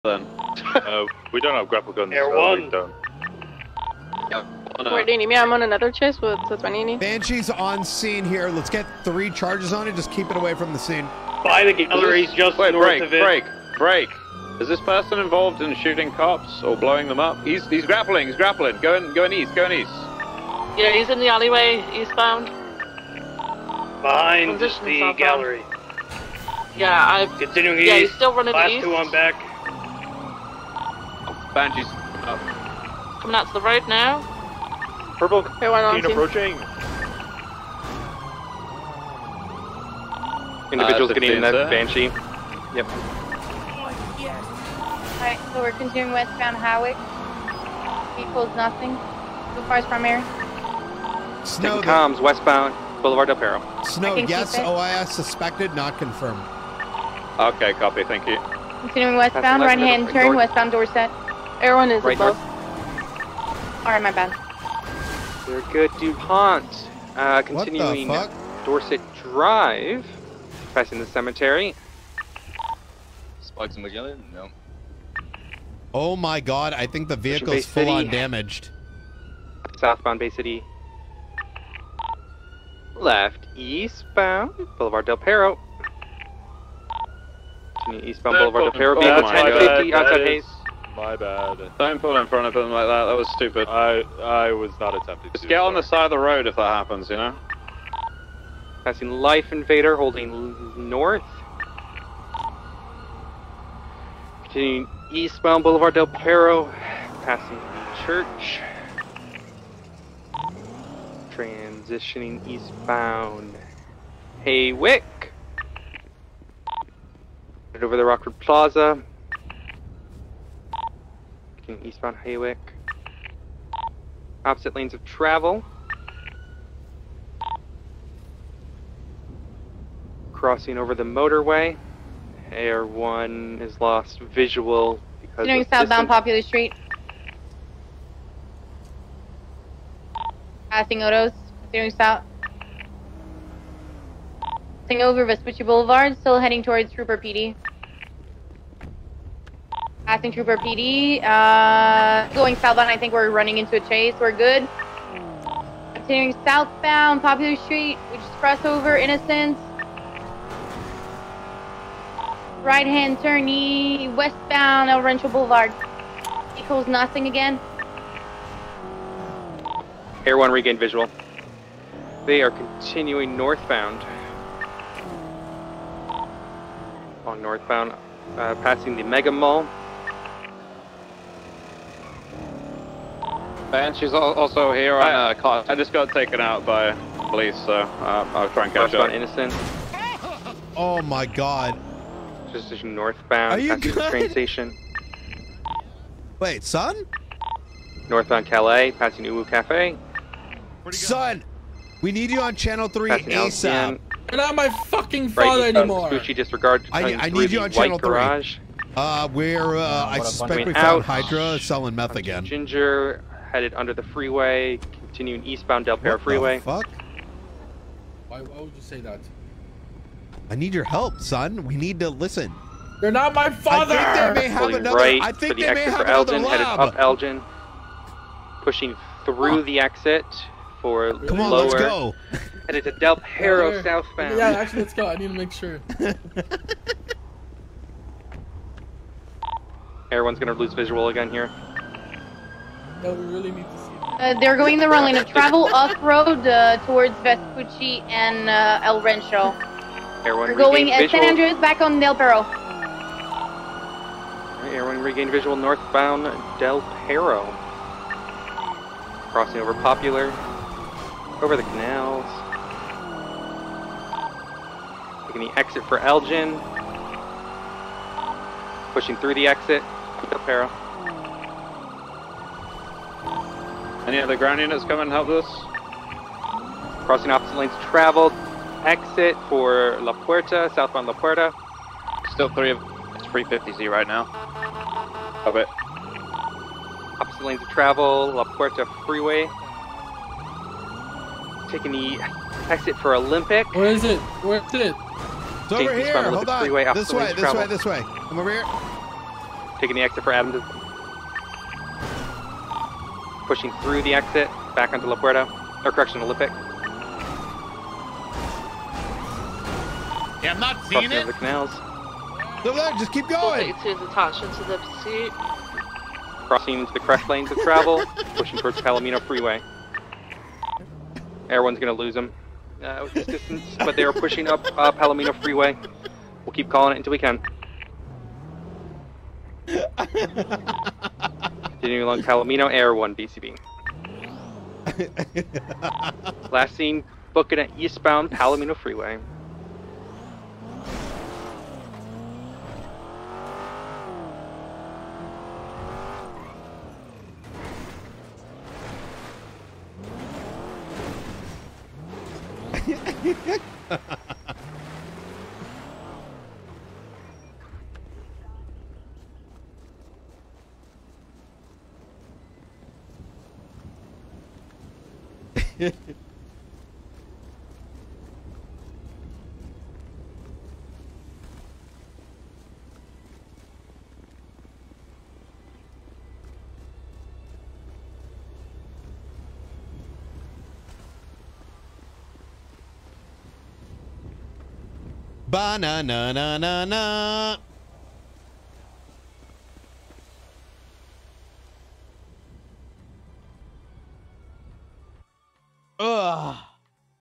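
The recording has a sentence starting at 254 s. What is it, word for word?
Right, everyone regained visual northbound Del Perro.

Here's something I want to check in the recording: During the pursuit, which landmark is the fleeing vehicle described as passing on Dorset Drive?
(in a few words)
the cemetery.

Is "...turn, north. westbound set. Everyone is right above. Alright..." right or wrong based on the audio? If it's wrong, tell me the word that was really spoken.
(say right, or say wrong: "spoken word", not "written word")
right.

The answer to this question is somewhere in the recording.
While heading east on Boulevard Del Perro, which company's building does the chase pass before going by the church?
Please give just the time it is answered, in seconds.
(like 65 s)
99 s.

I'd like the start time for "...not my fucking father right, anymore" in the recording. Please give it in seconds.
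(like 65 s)
204 s.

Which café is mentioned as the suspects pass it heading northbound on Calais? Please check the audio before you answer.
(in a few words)
Uwu Cafe.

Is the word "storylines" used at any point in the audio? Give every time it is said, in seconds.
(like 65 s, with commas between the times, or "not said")
not said.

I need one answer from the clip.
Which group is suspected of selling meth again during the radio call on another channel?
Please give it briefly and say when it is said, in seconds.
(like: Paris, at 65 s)
Hydra, at 211 s.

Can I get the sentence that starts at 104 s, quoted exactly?
Continuing eastbound Boulevard Del Perro, passing the church.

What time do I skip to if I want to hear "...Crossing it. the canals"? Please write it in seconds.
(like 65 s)
311 s.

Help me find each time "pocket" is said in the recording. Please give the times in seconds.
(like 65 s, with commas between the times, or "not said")
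not said.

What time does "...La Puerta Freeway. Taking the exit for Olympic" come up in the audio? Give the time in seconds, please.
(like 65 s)
288 s.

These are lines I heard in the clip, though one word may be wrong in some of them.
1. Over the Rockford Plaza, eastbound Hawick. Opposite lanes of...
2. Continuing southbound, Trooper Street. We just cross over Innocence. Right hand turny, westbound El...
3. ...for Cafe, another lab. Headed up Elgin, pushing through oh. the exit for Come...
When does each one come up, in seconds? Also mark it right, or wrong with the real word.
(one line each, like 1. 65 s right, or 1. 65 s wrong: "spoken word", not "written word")
1. 117 s right
2. 155 s wrong: "Popular", not "Trooper"
3. 225 s wrong: "Elgin", not "Cafe".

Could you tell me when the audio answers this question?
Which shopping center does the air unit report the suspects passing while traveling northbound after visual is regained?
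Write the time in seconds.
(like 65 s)
179 s.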